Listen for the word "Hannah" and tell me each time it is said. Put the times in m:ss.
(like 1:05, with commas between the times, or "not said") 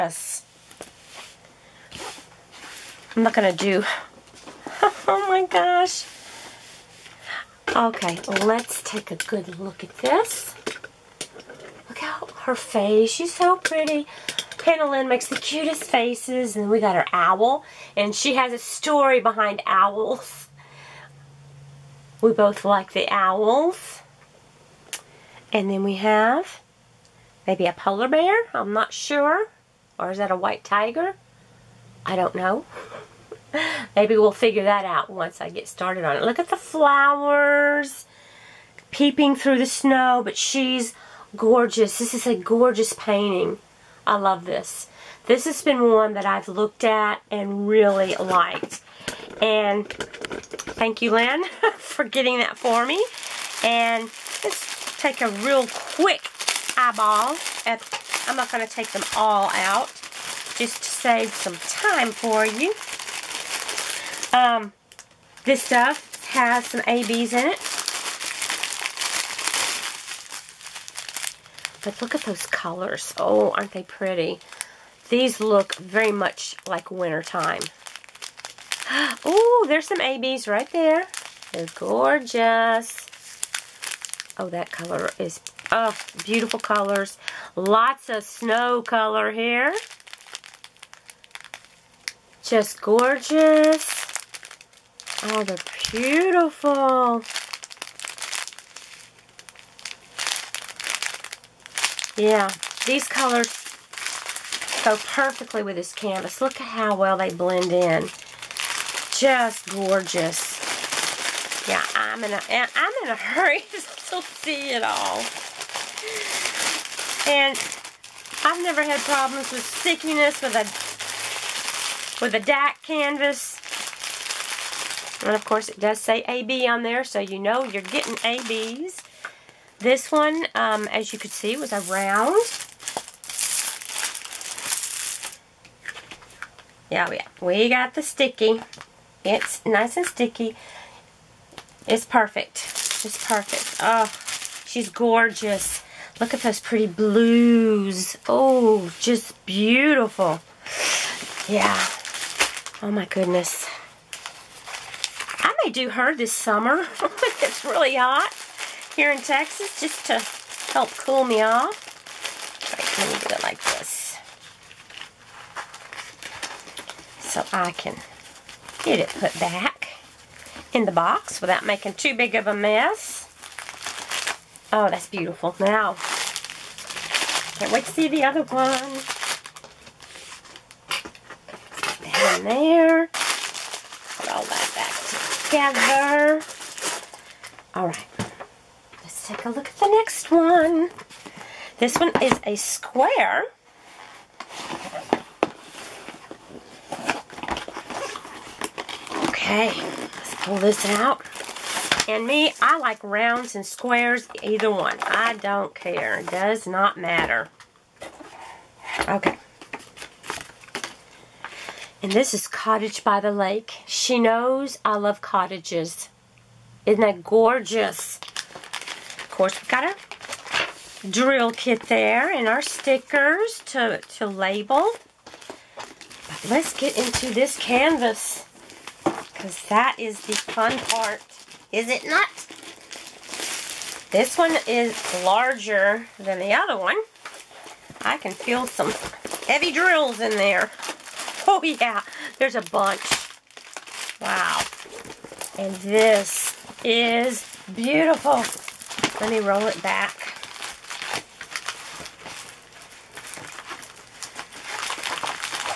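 0:14.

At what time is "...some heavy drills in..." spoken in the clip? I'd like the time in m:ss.
3:58.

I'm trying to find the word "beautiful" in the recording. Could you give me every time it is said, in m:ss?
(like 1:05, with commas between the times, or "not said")
1:26, 1:35, 2:29, 2:55, 4:07.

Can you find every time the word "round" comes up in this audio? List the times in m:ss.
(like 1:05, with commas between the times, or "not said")
2:11, 3:23.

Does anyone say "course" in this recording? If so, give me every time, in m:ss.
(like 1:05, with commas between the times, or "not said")
2:05, 3:39.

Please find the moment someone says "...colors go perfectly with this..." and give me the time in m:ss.
1:43.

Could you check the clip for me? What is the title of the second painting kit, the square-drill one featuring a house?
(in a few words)
Cottage by the Lake.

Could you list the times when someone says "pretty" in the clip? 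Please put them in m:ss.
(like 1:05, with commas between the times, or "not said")
0:13, 1:13, 2:26.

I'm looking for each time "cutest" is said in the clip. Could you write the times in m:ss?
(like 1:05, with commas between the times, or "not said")
0:15.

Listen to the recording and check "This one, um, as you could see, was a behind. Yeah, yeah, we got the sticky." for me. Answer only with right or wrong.
wrong.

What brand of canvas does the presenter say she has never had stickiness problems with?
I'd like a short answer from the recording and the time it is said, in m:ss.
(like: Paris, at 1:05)
DAC, at 2:02.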